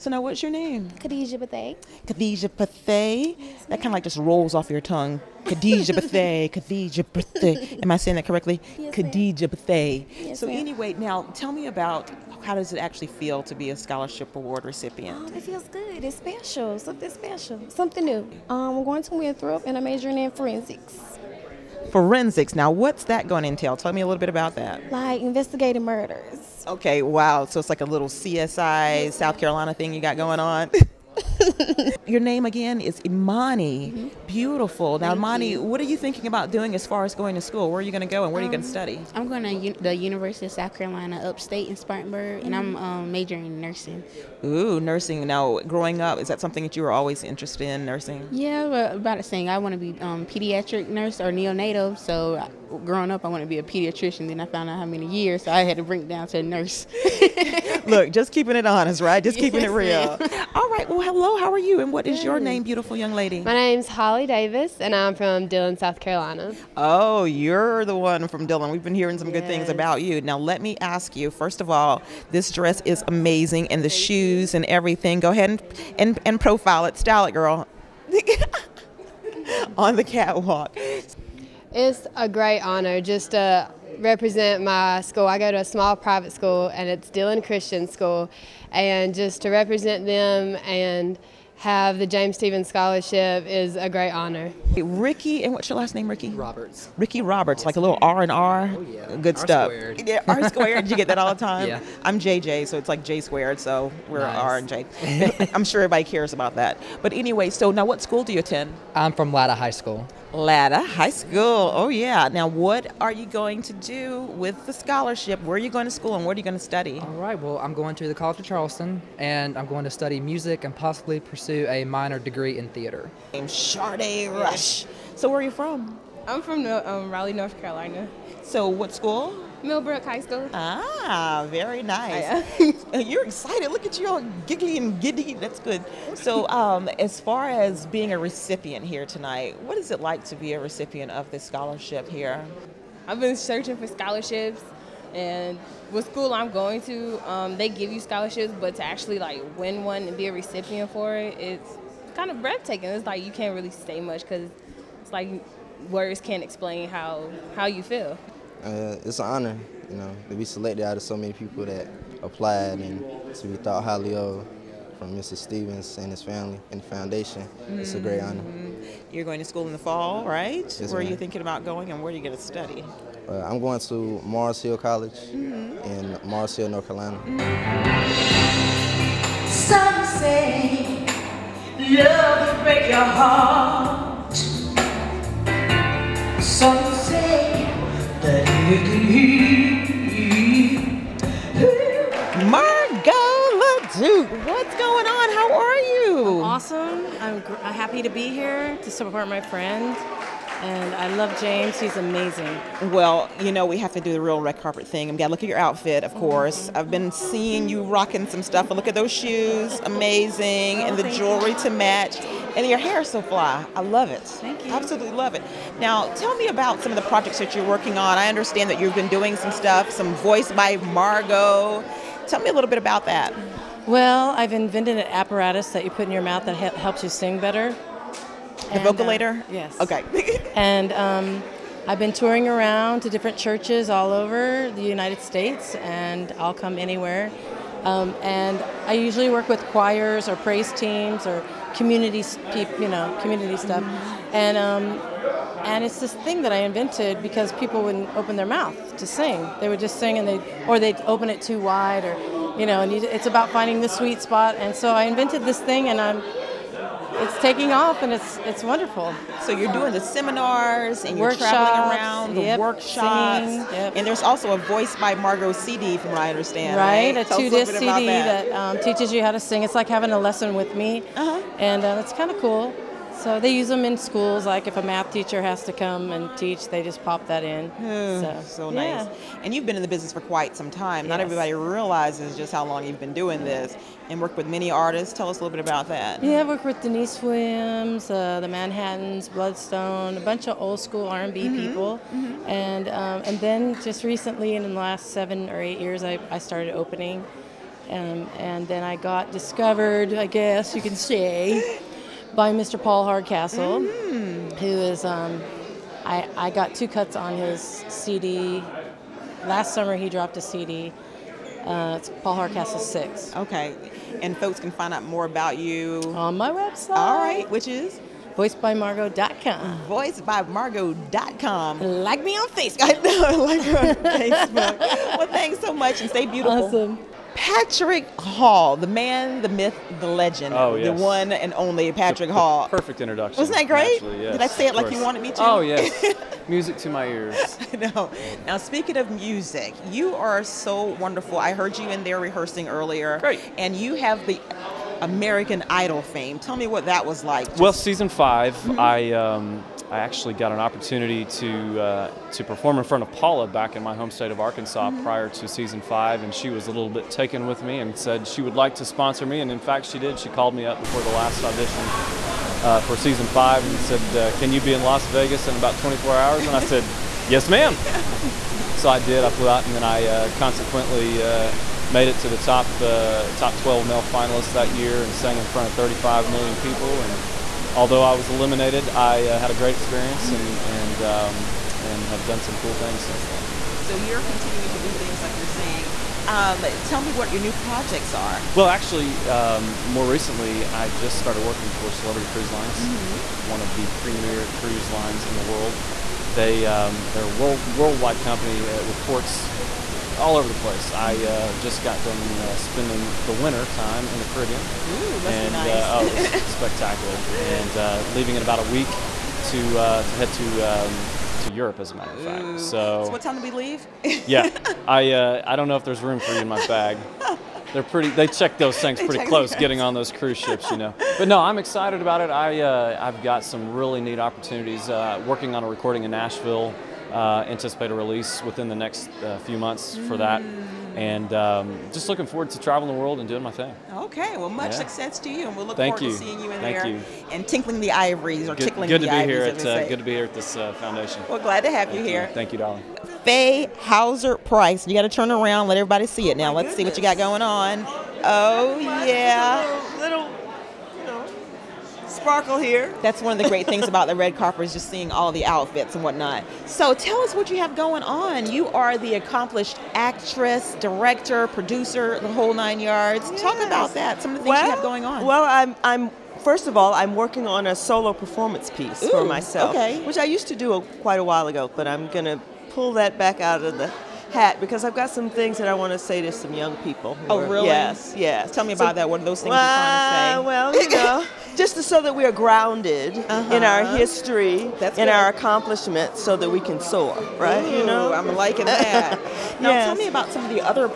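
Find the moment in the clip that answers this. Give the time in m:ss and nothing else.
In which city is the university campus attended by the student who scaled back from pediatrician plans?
0:41.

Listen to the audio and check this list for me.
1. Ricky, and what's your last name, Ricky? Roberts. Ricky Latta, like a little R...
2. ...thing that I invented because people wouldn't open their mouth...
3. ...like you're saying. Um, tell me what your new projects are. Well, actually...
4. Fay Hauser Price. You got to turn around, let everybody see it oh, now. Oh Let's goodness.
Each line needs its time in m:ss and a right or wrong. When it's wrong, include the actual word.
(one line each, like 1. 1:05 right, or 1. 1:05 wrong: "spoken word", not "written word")
1. 1:34 wrong: "Roberts", not "Latta"
2. 4:06 right
3. 6:25 right
4. 7:23 right.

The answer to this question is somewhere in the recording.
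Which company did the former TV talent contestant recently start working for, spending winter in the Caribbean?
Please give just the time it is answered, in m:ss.
6:31.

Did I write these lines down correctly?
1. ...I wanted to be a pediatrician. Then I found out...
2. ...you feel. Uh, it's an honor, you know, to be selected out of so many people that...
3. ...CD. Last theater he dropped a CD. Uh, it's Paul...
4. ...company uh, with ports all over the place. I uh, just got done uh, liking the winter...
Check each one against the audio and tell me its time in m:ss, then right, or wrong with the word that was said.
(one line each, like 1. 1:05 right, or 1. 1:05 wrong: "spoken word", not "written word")
1. 0:53 right
2. 2:37 right
3. 5:07 wrong: "summer", not "theater"
4. 6:38 wrong: "spending", not "liking".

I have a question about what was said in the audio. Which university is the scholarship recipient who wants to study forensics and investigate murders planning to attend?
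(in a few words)
Winthrop.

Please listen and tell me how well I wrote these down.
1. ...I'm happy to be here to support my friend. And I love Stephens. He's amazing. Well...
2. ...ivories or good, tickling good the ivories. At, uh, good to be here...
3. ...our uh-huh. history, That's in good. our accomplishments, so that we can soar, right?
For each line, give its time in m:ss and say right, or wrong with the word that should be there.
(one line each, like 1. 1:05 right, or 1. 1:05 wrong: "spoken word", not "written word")
1. 3:17 wrong: "James", not "Stephens"
2. 7:17 right
3. 8:03 right.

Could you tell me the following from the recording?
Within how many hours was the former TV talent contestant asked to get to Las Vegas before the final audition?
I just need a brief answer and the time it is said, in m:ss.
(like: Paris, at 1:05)
24 hours, at 6:05.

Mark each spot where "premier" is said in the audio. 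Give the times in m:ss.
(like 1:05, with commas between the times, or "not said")
6:34.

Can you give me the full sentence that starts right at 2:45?
Stephens and his family and the foundation.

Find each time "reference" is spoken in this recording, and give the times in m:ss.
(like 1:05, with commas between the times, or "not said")
not said.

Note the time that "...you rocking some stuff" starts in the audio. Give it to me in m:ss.
3:27.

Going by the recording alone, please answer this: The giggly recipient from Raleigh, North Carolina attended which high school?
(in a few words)
Millbrook High School.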